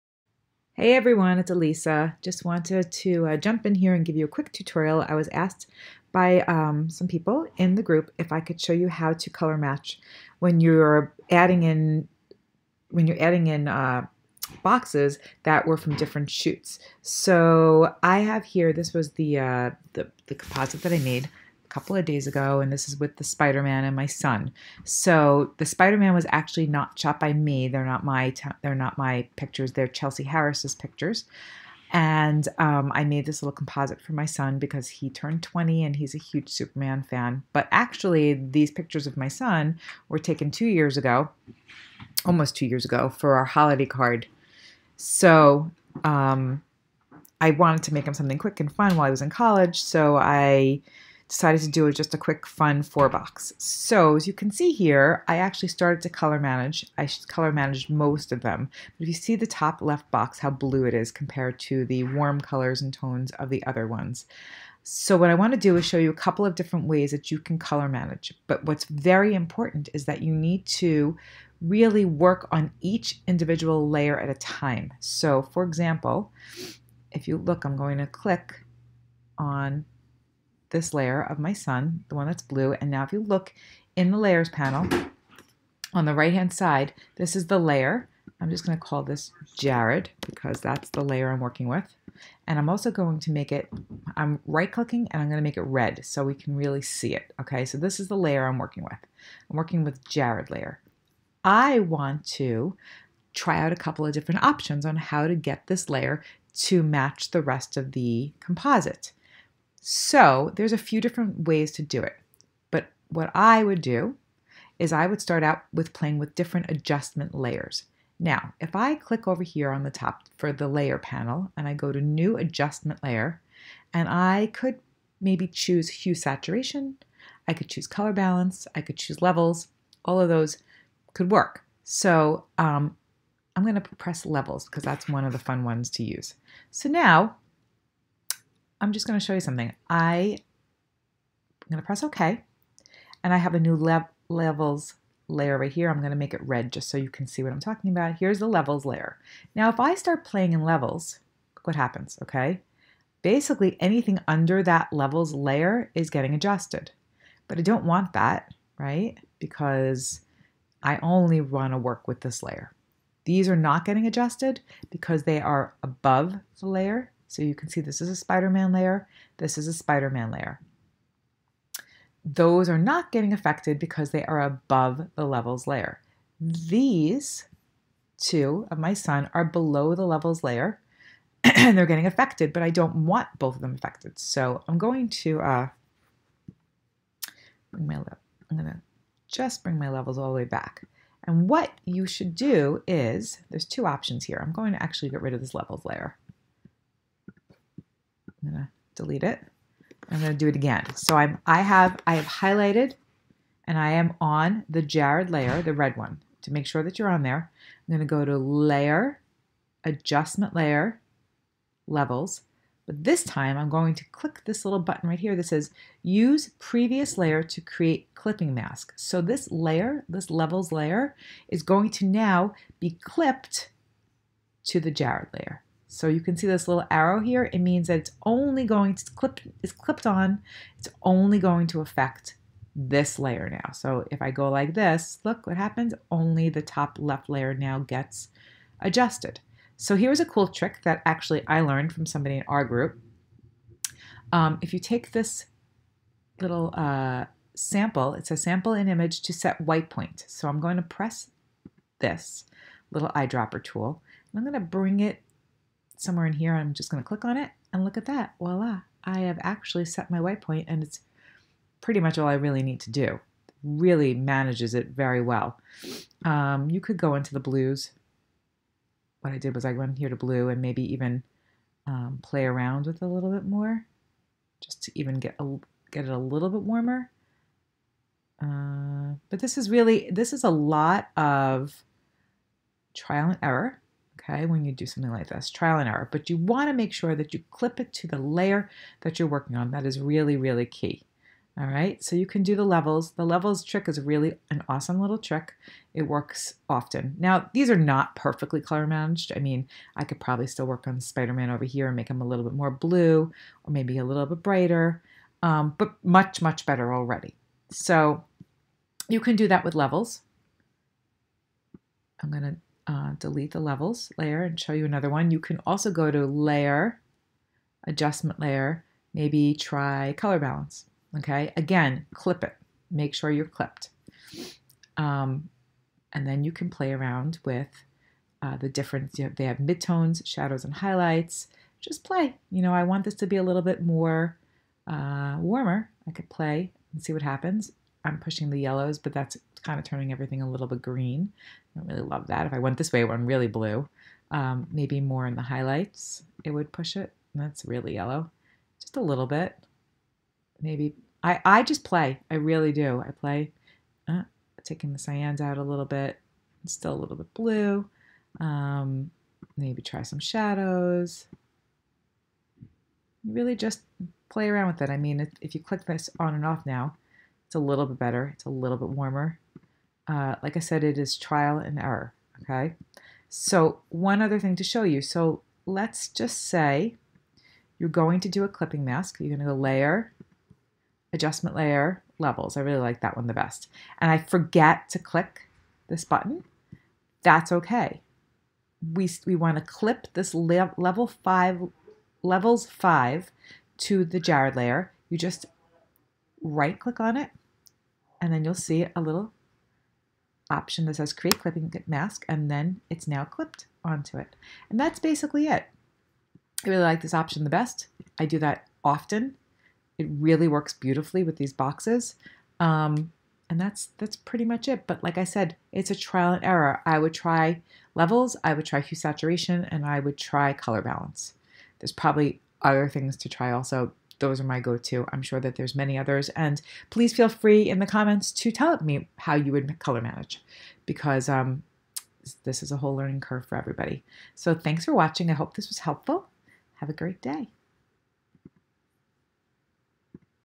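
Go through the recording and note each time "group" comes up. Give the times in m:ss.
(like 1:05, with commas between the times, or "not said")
0:07, 4:02.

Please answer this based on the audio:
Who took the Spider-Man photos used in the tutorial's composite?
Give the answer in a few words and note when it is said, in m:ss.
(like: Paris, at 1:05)
Chelsea Harris, at 0:29.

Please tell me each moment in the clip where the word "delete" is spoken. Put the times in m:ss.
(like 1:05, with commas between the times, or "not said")
3:18, 5:13.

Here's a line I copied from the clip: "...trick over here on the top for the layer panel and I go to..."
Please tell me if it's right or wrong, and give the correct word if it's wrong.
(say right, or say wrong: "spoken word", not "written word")
wrong: "click", not "trick".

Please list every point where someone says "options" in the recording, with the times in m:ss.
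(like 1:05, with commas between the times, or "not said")
1:44, 3:13, 6:40, 6:47.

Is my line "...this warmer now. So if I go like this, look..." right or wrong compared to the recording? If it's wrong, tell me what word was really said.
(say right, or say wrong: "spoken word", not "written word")
wrong: "layer", not "warmer".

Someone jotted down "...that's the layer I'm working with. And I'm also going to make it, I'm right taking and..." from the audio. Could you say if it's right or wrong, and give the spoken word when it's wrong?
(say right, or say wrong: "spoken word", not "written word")
wrong: "clicking", not "taking".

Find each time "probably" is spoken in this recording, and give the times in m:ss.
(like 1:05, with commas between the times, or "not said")
5:00, 7:01.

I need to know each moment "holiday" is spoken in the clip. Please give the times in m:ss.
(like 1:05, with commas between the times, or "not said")
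0:43.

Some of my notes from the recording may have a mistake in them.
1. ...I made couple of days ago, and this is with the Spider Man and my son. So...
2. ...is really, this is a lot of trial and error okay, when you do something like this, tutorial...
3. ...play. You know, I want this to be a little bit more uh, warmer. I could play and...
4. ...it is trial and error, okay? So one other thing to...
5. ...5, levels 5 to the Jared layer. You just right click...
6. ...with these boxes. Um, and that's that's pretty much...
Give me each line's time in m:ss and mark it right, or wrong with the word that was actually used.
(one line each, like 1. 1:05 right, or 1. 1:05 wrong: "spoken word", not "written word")
1. 0:20 right
2. 4:39 wrong: "trial", not "tutorial"
3. 5:32 right
4. 6:10 right
5. 6:31 right
6. 6:51 right.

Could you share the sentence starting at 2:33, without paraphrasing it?
Basically, anything under that levels layer is getting adjusted.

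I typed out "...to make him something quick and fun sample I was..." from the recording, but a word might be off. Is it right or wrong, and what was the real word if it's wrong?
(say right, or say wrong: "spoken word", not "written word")
wrong: "while", not "sample".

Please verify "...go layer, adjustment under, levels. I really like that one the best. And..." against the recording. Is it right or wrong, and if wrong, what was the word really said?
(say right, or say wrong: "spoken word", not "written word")
wrong: "layer", not "under".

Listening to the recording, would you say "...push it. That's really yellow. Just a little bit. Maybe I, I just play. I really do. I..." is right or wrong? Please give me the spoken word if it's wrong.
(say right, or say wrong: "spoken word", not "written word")
right.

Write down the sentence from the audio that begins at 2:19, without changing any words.
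I, I'm going to press OK.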